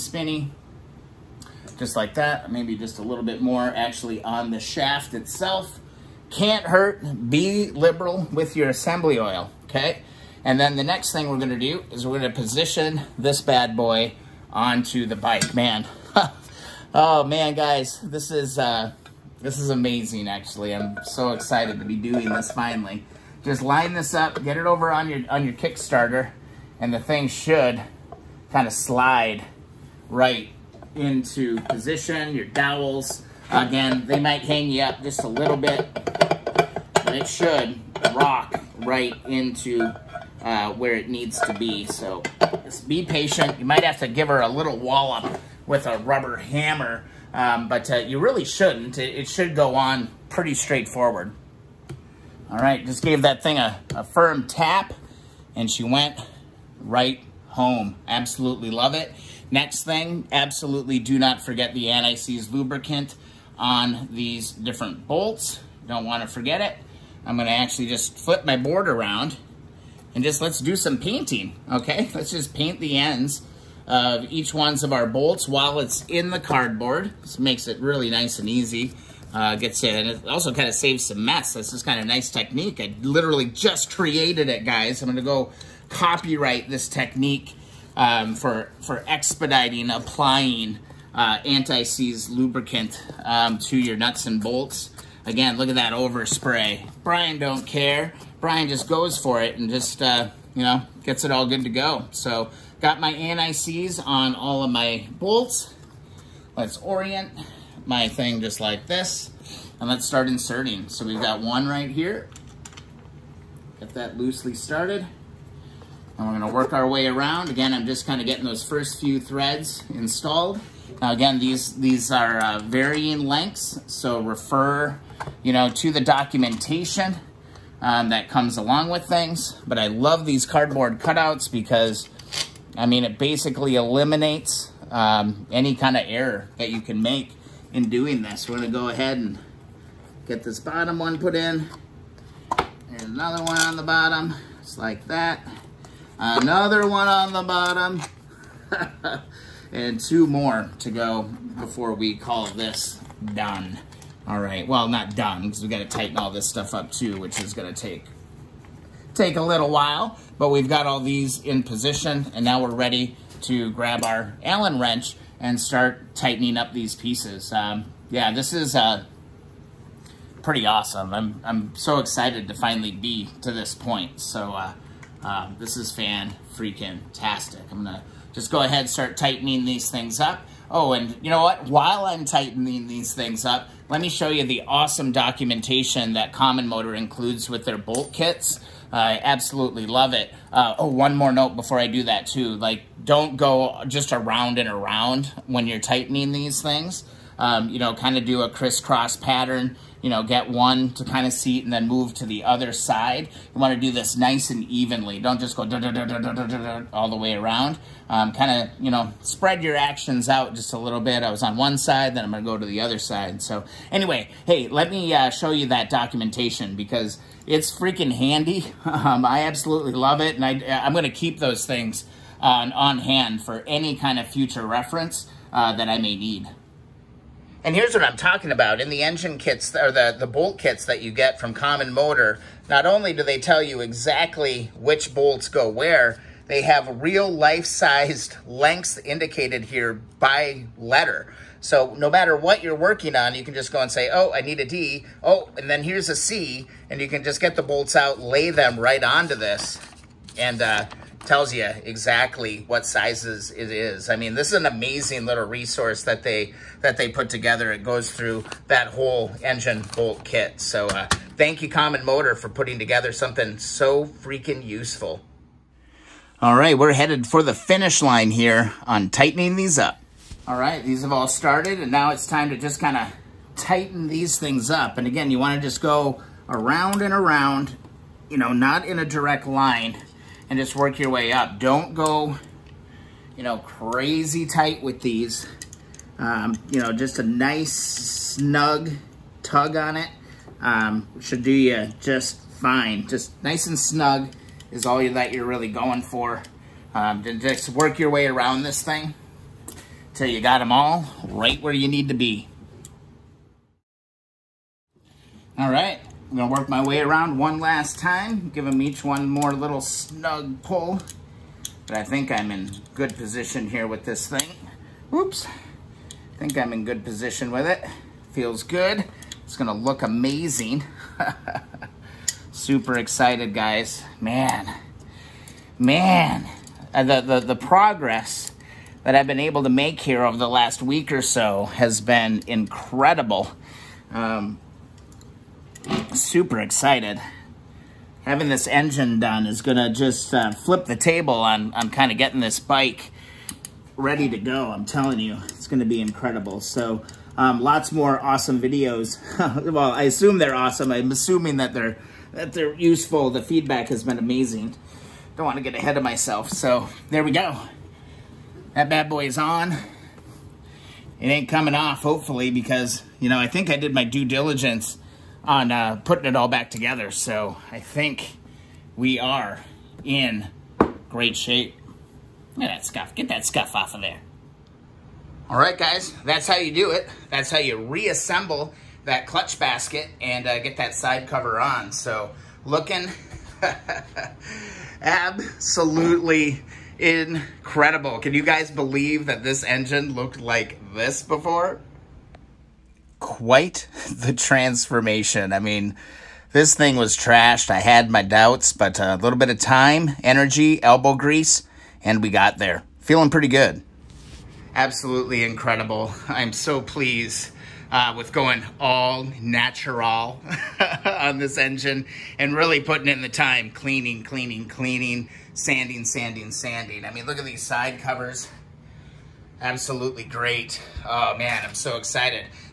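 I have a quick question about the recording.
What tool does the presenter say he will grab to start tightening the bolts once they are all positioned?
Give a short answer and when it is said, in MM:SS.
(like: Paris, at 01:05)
Allen wrench, at 02:44.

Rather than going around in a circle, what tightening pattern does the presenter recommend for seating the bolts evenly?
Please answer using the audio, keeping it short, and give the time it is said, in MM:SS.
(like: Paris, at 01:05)
crisscross pattern, at 03:18.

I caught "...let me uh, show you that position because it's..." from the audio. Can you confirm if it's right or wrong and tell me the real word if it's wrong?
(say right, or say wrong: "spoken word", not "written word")
wrong: "documentation", not "position".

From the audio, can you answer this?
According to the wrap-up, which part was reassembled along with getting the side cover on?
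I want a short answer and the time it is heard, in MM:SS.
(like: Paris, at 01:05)
clutch basket, at 06:19.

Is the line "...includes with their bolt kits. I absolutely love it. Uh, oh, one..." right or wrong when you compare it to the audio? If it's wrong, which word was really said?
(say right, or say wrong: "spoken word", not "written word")
right.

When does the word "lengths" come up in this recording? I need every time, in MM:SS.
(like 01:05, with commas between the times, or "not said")
02:03, 03:58.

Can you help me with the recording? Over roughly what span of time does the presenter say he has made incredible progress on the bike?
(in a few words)
the last week.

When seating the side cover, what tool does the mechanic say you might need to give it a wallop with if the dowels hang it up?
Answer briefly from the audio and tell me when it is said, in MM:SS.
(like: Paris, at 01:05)
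rubber hammer, at 00:45.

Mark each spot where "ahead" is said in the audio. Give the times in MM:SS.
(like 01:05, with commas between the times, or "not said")
02:18, 02:58, 05:55.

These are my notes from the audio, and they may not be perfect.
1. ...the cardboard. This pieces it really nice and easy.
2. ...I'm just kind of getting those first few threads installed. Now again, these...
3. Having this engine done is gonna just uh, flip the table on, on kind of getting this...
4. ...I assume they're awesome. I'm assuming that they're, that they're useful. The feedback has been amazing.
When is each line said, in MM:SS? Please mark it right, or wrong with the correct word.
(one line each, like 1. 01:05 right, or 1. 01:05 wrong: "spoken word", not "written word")
1. 01:16 wrong: "makes", not "pieces"
2. 01:57 right
3. 05:38 right
4. 05:49 right.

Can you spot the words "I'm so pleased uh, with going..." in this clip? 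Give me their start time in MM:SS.
06:46.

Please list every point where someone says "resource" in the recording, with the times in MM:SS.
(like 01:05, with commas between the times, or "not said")
04:15.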